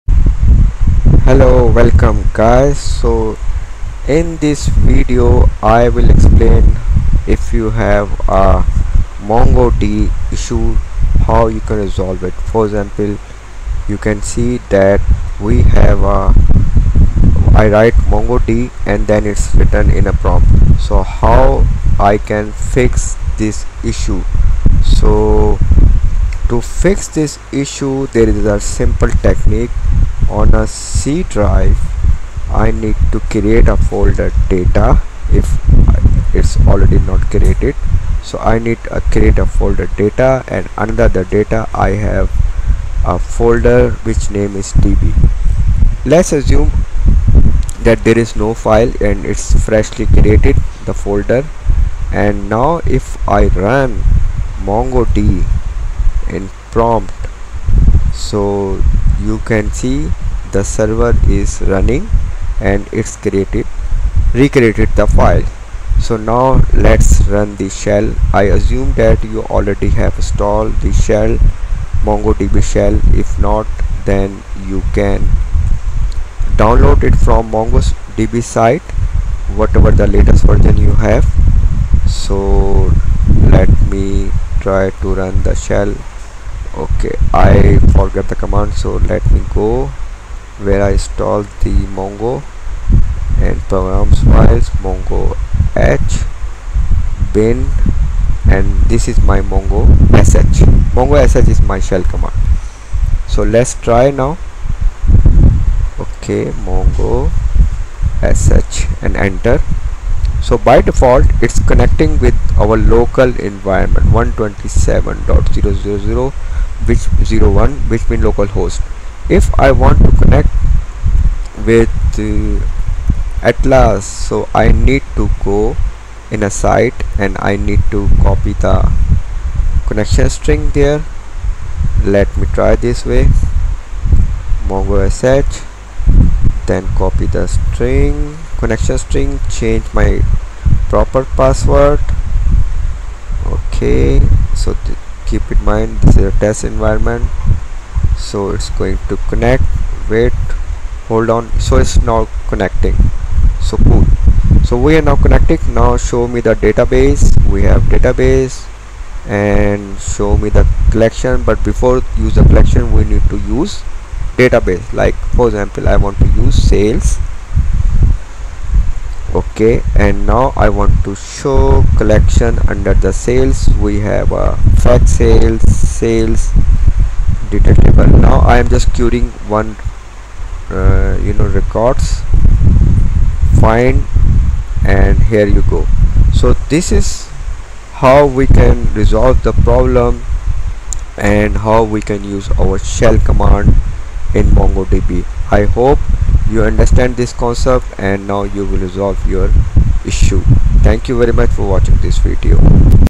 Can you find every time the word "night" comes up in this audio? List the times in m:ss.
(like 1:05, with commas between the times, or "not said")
not said.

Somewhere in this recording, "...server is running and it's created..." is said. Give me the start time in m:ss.
1:00.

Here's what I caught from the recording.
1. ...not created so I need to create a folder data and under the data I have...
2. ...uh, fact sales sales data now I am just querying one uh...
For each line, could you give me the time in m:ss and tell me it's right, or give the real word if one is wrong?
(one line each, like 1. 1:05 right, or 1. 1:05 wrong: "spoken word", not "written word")
1. 0:36 right
2. 2:54 right.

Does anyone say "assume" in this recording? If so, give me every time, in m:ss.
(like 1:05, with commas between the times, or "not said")
0:46, 1:08.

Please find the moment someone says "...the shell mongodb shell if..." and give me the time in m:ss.
1:10.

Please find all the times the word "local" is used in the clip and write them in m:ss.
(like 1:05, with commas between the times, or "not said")
1:52, 1:58.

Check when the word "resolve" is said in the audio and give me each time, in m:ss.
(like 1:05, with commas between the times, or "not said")
0:11, 3:08, 3:18.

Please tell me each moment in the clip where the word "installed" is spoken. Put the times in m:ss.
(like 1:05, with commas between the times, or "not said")
1:10, 1:30.